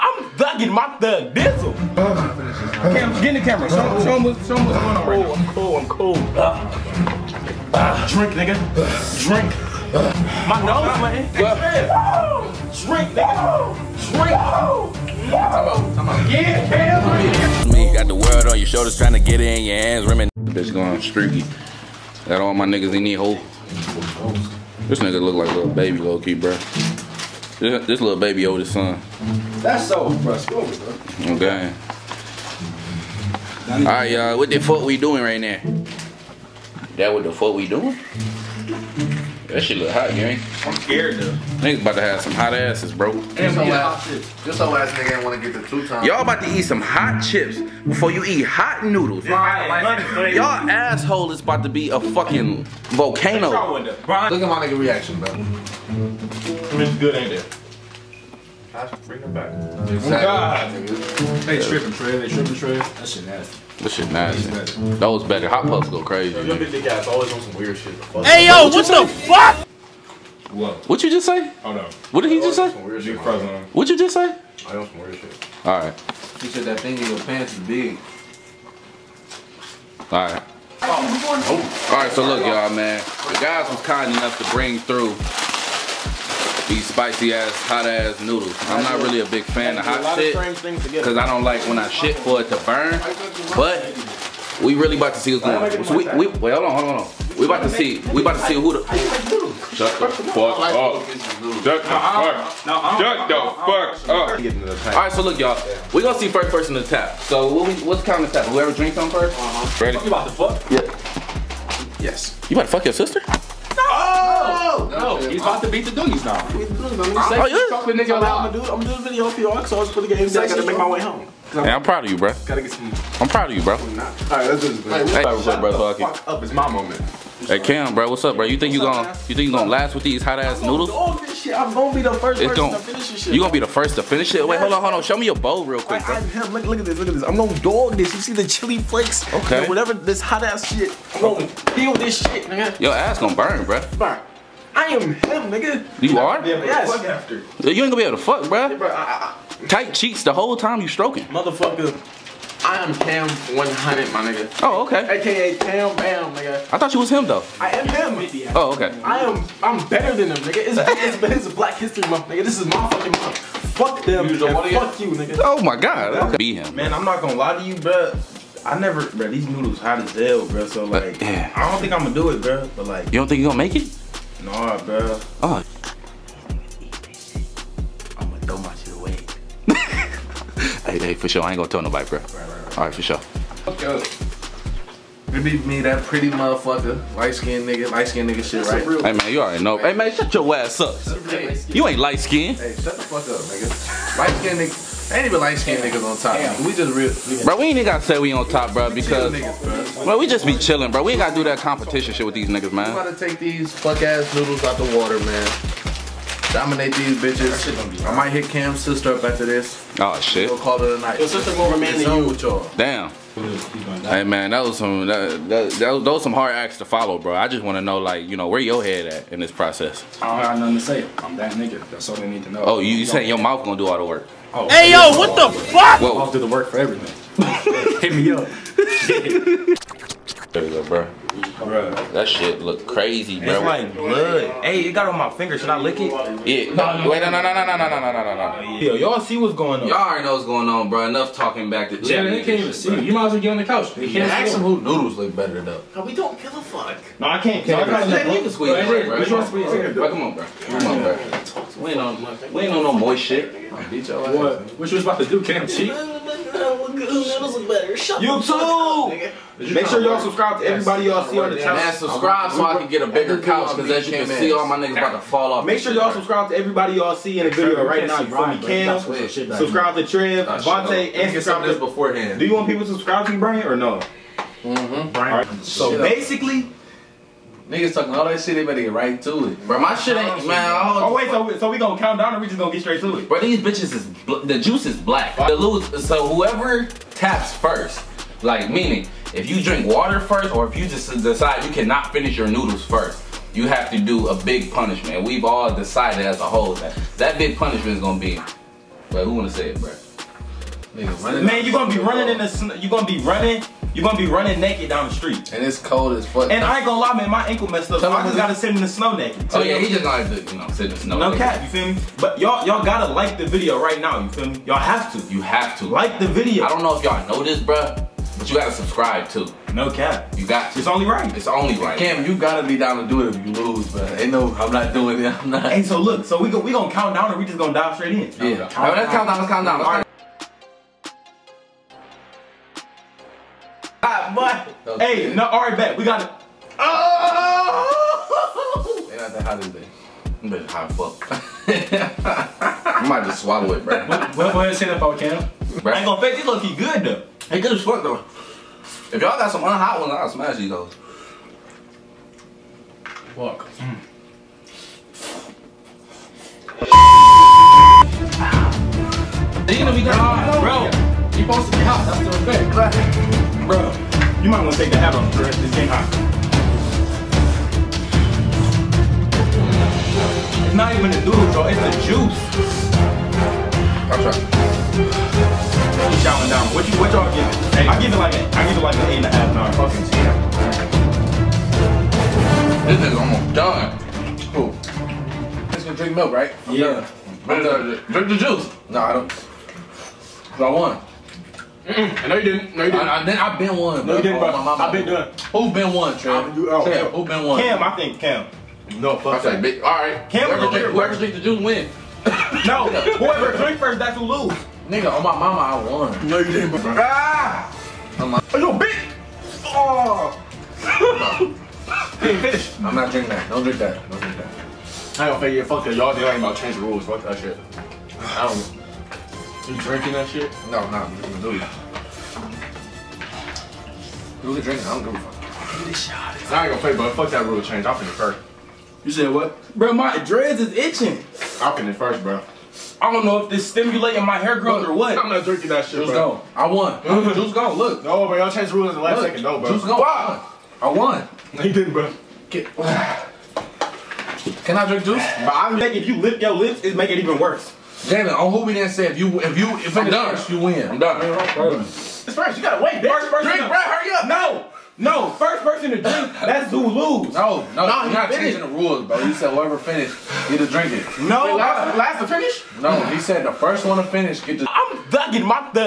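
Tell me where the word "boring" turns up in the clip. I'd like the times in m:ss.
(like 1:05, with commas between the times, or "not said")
not said.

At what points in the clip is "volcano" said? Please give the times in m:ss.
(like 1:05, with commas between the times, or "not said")
0:52, 5:44.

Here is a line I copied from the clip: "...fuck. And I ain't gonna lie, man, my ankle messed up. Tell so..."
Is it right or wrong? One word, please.
right.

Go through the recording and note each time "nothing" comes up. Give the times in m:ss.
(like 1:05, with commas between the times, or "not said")
3:40.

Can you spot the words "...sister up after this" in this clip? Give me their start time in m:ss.
3:28.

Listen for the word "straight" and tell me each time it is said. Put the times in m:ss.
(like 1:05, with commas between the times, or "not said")
4:42, 5:27.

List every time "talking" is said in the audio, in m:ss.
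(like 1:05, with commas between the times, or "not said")
4:01, 4:37.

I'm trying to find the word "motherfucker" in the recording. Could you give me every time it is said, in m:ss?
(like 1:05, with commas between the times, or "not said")
2:31, 3:06.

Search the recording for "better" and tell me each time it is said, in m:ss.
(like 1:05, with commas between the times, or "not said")
1:05, 2:39, 4:05, 4:38, 5:40.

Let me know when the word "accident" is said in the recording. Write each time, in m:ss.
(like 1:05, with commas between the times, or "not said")
not said.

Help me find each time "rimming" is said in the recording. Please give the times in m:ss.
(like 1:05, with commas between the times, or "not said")
0:20.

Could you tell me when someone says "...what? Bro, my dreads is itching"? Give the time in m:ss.
7:09.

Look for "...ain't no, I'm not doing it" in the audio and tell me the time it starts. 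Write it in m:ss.
5:24.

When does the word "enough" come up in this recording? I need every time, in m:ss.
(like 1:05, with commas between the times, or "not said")
1:24, 4:01.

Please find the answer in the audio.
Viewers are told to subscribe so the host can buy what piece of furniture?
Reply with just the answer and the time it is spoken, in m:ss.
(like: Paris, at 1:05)
a bigger couch, at 4:23.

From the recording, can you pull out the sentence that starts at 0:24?
This nigga look like a little baby low key, bro.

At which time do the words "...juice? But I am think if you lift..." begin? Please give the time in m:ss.
7:25.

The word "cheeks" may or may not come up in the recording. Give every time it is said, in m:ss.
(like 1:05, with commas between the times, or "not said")
2:29, 4:15.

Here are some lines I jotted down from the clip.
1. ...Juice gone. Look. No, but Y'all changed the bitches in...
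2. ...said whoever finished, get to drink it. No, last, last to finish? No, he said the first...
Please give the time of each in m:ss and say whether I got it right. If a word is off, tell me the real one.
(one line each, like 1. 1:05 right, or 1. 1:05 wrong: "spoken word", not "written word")
1. 7:17 wrong: "rules", not "bitches"
2. 7:39 right.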